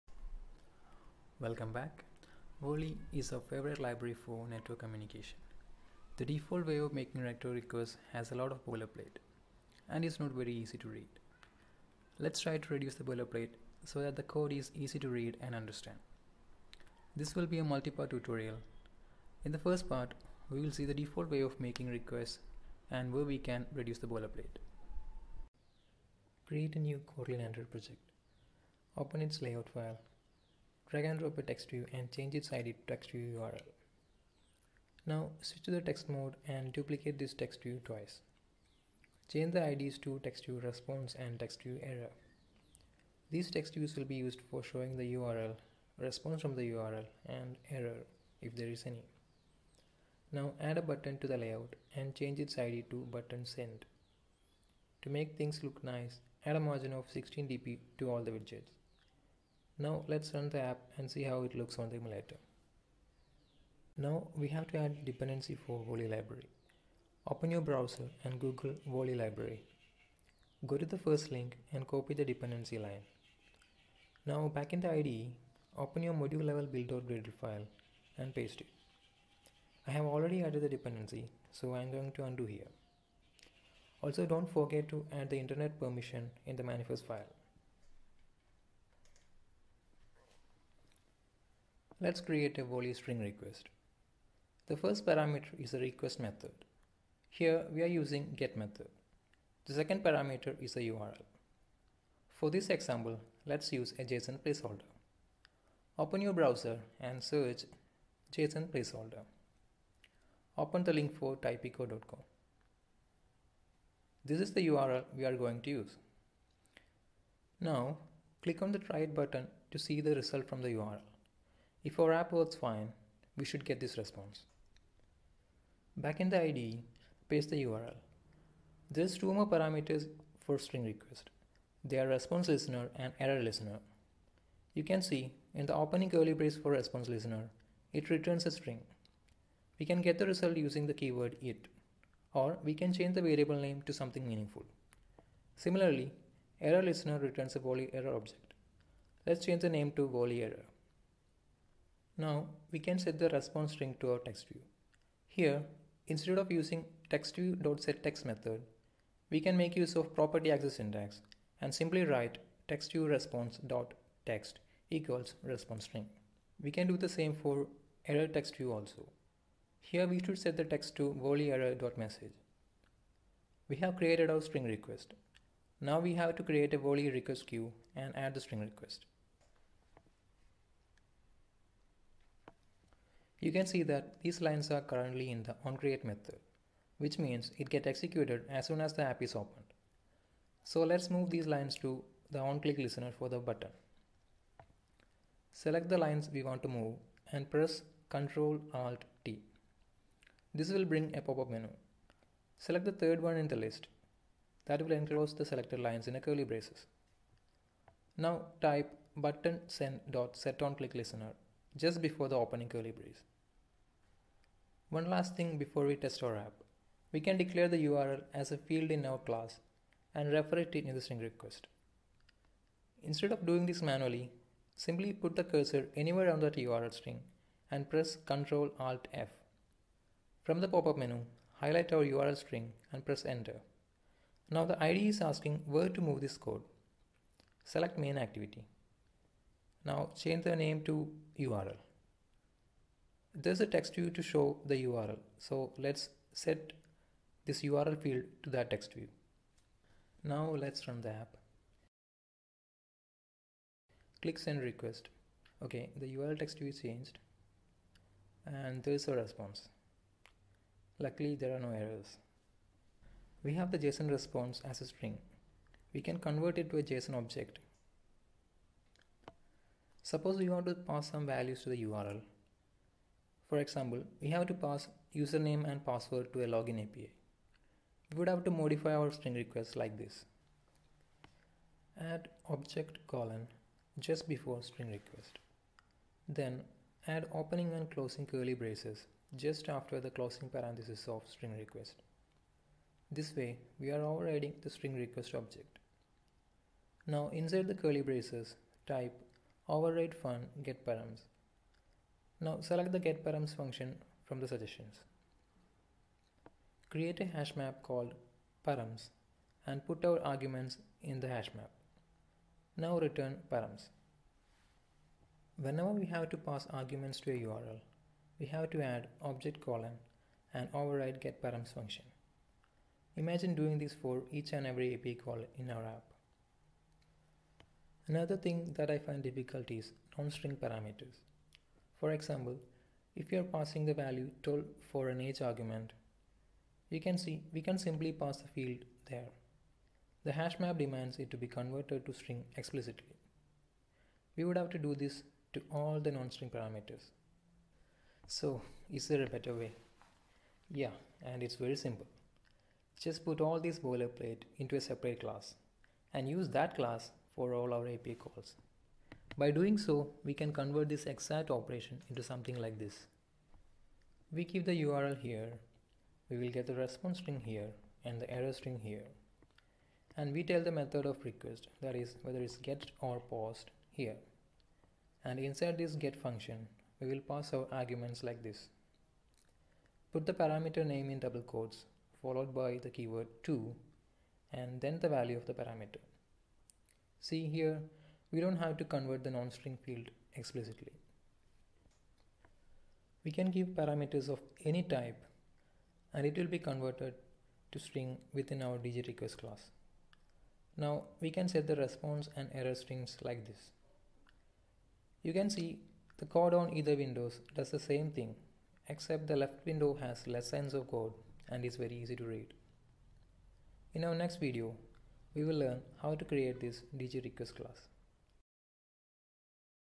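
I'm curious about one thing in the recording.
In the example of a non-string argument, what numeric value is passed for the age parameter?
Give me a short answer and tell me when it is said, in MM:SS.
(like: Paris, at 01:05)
12, at 05:34.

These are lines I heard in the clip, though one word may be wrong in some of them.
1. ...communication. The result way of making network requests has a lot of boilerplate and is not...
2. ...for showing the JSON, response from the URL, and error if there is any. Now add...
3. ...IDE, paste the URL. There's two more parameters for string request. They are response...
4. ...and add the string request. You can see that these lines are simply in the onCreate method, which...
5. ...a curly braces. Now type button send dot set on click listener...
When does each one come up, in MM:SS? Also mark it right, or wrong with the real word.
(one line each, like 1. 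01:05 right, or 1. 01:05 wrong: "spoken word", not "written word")
1. 00:04 wrong: "default", not "result"
2. 00:44 wrong: "URL", not "JSON"
3. 02:06 right
4. 02:57 wrong: "currently", not "simply"
5. 03:26 right.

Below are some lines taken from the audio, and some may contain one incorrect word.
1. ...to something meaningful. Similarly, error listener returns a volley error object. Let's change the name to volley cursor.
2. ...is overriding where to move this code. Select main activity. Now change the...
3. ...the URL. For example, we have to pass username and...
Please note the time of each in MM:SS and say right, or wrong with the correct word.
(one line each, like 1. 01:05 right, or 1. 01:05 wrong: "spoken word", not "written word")
1. 02:23 wrong: "error", not "cursor"
2. 03:55 wrong: "asking", not "overriding"
3. 04:31 right.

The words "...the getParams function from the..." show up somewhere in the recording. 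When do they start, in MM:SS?
05:02.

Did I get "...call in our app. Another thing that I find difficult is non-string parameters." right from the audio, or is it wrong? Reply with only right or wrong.
right.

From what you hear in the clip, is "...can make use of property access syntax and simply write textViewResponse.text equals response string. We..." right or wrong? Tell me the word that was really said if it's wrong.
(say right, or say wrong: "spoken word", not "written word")
right.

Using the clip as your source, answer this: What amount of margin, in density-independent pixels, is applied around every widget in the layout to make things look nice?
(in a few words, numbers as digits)
16 dp.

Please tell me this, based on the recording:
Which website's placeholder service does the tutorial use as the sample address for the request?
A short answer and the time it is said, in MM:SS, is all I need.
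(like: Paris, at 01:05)
typicode.com, at 01:51.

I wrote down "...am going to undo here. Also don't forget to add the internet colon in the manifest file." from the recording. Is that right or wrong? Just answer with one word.
wrong.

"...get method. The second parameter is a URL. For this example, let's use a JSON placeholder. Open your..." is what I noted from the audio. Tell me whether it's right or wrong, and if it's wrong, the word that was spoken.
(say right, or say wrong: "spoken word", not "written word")
right.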